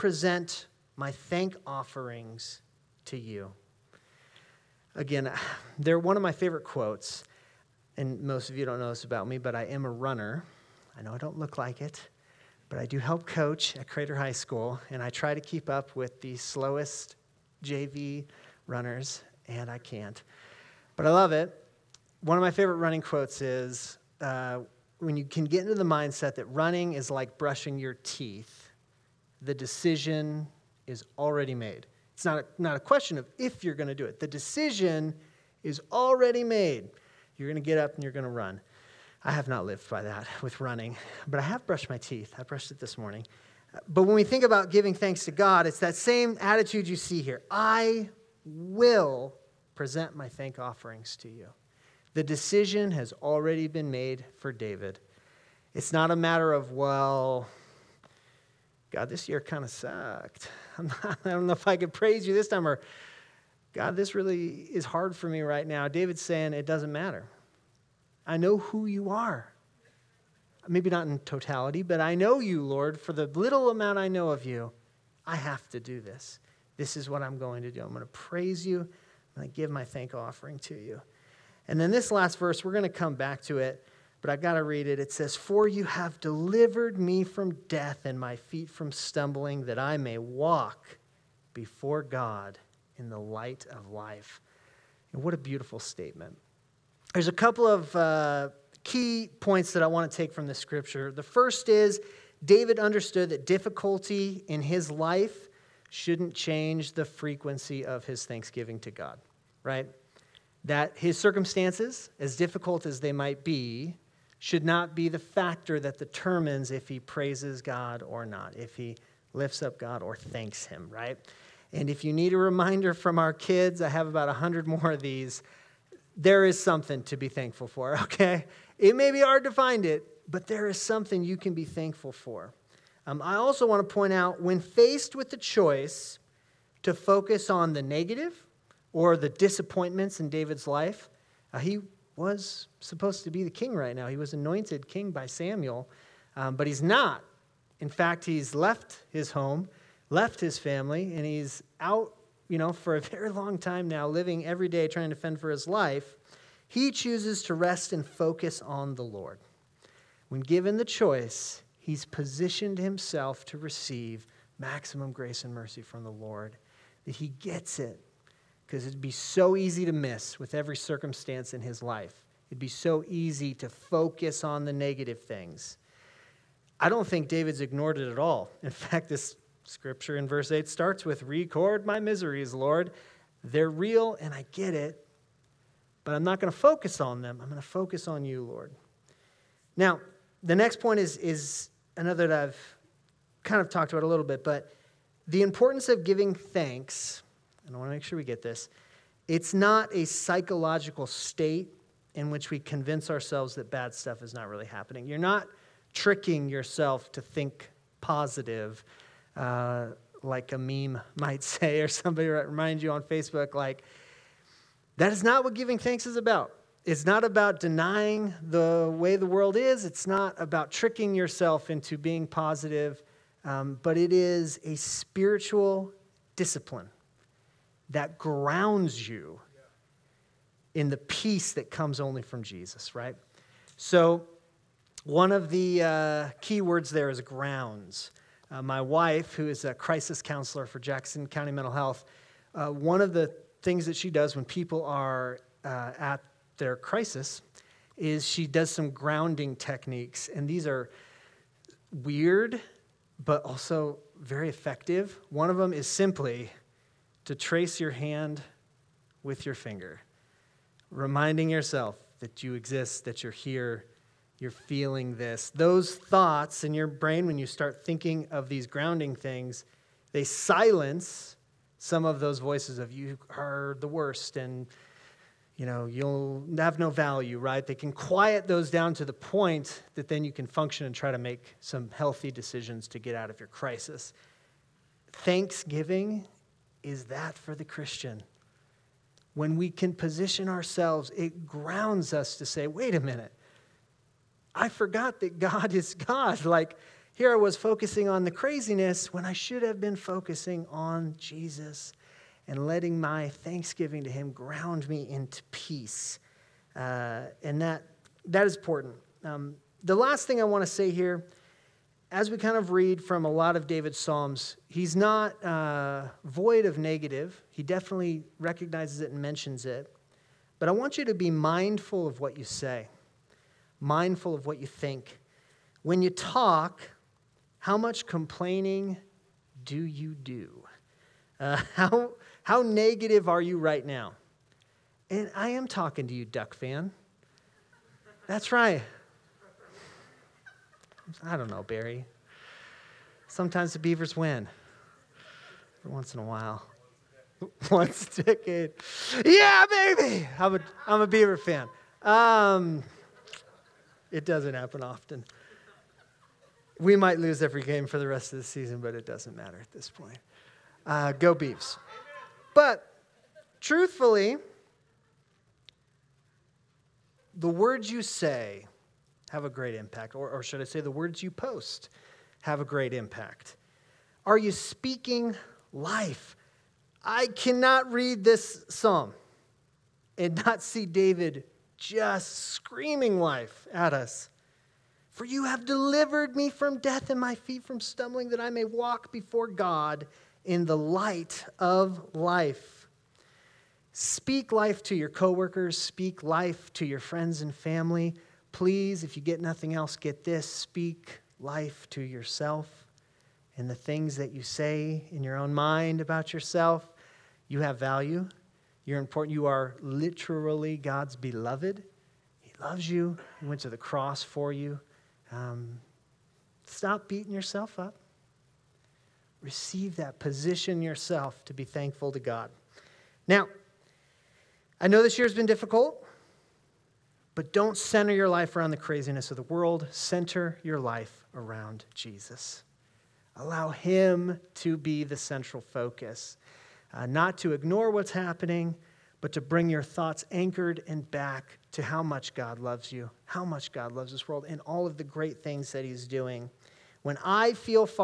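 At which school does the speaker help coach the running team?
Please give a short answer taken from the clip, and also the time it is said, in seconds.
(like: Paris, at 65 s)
Crater High School, at 13 s.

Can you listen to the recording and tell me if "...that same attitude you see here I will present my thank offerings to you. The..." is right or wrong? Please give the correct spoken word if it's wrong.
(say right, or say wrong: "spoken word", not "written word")
right.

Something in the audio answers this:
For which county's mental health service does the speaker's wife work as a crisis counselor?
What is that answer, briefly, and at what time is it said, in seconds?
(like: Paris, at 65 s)
Jackson County, at 240 s.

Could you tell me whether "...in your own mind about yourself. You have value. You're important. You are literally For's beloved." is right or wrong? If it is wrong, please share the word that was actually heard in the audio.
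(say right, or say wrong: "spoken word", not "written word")
wrong: "God", not "For".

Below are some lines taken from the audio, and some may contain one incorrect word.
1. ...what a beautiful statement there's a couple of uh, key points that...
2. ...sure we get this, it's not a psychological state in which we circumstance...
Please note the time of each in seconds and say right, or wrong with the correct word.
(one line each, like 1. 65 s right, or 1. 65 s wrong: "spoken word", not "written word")
1. 95 s right
2. 198 s wrong: "convince", not "circumstance".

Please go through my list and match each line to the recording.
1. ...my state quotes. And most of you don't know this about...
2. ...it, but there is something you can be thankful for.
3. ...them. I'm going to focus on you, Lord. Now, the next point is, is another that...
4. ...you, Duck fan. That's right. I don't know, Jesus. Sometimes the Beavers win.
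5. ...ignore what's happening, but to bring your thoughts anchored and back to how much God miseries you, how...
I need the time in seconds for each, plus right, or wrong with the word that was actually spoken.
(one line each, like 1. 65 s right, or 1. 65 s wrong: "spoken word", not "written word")
1. 6 s wrong: "favorite", not "state"
2. 129 s right
3. 187 s right
4. 336 s wrong: "Barry", not "Jesus"
5. 437 s wrong: "loves", not "miseries".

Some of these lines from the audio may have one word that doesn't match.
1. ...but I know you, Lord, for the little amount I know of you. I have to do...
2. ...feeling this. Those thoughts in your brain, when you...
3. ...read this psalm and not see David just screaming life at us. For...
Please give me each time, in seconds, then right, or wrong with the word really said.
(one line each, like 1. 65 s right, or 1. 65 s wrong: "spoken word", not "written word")
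1. 71 s right
2. 264 s right
3. 377 s right.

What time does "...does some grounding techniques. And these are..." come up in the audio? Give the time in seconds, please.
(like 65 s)
248 s.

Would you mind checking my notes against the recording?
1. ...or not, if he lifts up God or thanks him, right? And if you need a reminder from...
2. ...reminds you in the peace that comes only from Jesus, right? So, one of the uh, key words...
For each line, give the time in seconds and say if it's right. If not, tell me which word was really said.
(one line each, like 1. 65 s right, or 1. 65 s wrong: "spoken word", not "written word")
1. 118 s right
2. 228 s wrong: "grounds", not "reminds".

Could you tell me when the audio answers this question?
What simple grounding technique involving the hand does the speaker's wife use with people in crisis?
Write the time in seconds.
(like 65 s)
257 s.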